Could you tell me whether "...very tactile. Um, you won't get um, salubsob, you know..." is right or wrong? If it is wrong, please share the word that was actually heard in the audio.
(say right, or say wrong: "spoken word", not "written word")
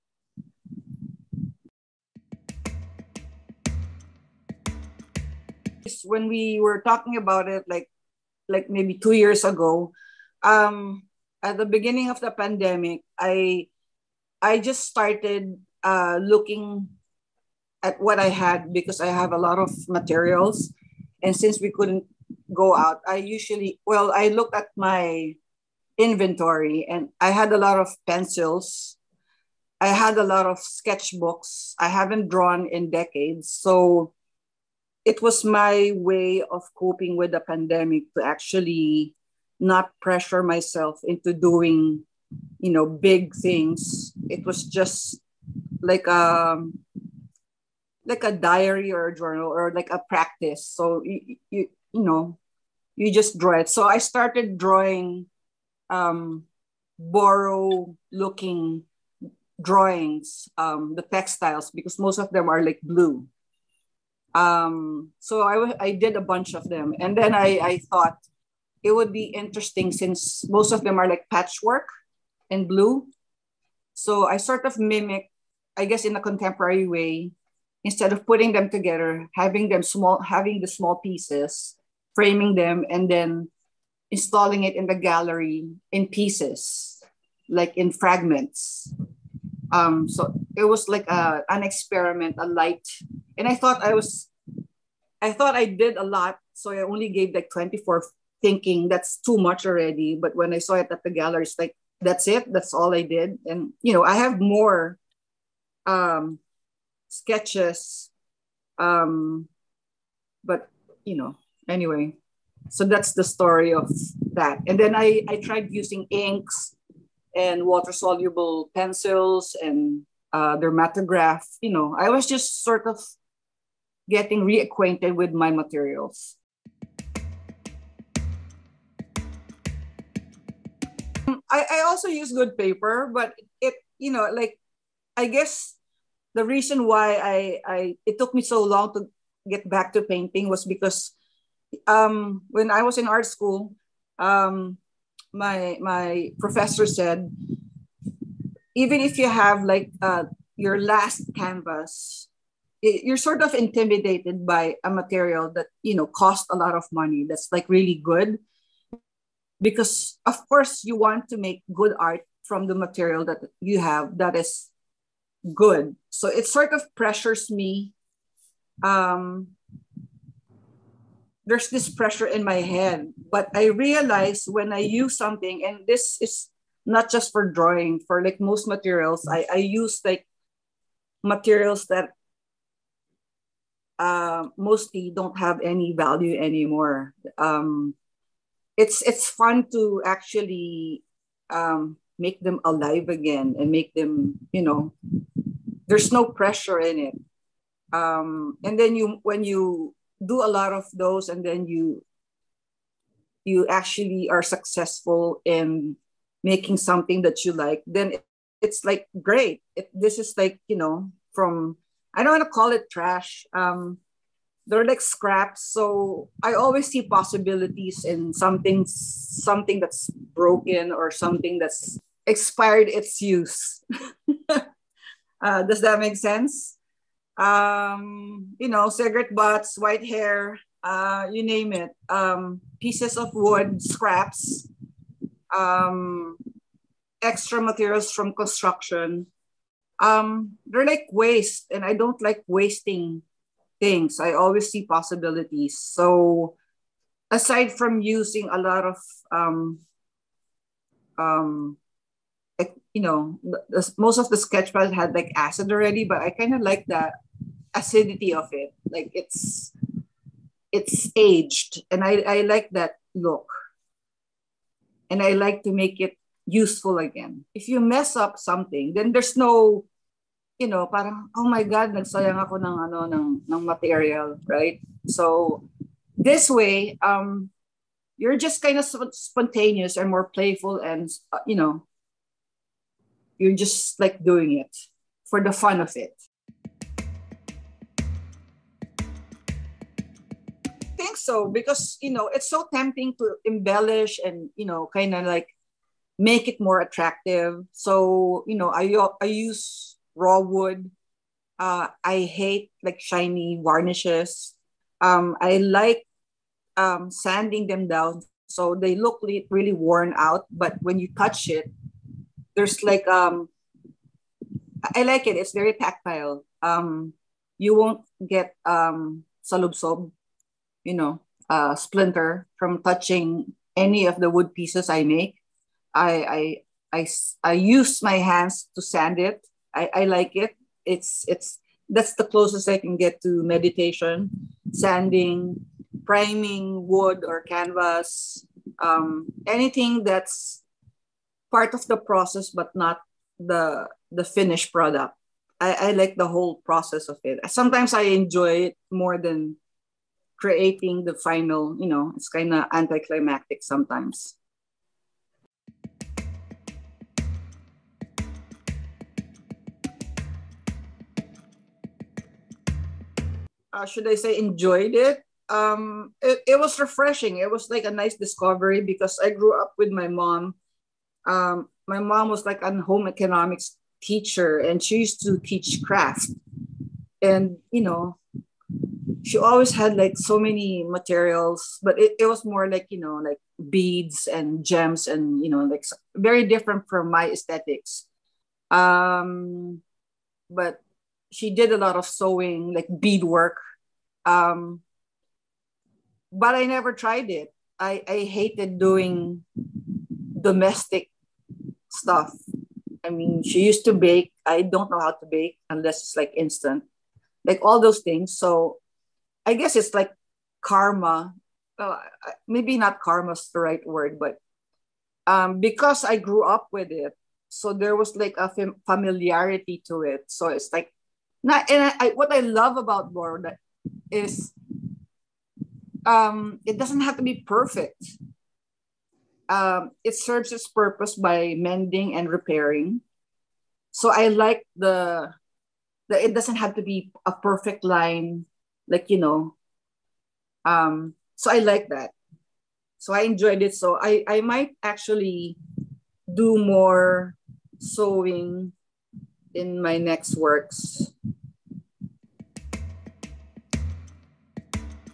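right.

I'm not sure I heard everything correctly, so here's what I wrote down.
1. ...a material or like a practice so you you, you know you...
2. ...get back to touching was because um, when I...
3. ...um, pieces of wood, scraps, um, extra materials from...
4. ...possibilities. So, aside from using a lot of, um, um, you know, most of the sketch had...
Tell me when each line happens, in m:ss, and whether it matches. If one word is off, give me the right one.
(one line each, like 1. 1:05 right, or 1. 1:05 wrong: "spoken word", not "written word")
1. 0:49 wrong: "journal", not "material"
2. 2:19 wrong: "painting", not "touching"
3. 3:52 right
4. 4:04 right.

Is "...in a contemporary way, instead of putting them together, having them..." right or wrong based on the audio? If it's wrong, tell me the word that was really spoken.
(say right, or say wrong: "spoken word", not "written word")
right.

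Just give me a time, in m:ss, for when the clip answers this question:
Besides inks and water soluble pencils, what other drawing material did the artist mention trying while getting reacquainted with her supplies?
2:00.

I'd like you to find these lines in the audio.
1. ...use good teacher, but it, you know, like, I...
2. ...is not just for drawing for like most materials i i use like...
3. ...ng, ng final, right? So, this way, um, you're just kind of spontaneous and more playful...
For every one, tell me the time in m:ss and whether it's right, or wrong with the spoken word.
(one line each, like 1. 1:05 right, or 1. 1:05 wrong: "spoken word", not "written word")
1. 2:12 wrong: "paper", not "teacher"
2. 2:56 right
3. 4:33 wrong: "material", not "final".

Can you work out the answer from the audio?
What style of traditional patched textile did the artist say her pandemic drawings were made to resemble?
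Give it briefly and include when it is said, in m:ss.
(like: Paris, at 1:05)
Boro, at 0:56.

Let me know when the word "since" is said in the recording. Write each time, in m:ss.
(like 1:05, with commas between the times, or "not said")
0:21, 1:09.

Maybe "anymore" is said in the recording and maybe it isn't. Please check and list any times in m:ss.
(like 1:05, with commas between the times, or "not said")
3:06.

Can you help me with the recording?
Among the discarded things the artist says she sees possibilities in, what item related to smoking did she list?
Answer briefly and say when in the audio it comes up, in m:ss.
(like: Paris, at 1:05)
Cigarette butts, at 3:48.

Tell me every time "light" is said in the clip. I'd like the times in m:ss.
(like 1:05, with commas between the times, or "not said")
1:32.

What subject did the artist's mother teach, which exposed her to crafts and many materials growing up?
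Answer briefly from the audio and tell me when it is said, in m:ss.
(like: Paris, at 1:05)
Home economics, at 6:12.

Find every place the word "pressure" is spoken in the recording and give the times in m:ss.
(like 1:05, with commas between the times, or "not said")
0:40, 2:46, 2:51, 3:16.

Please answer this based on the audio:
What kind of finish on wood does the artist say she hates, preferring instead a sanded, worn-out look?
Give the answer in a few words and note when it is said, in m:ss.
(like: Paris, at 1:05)
Shiny varnishes, at 5:02.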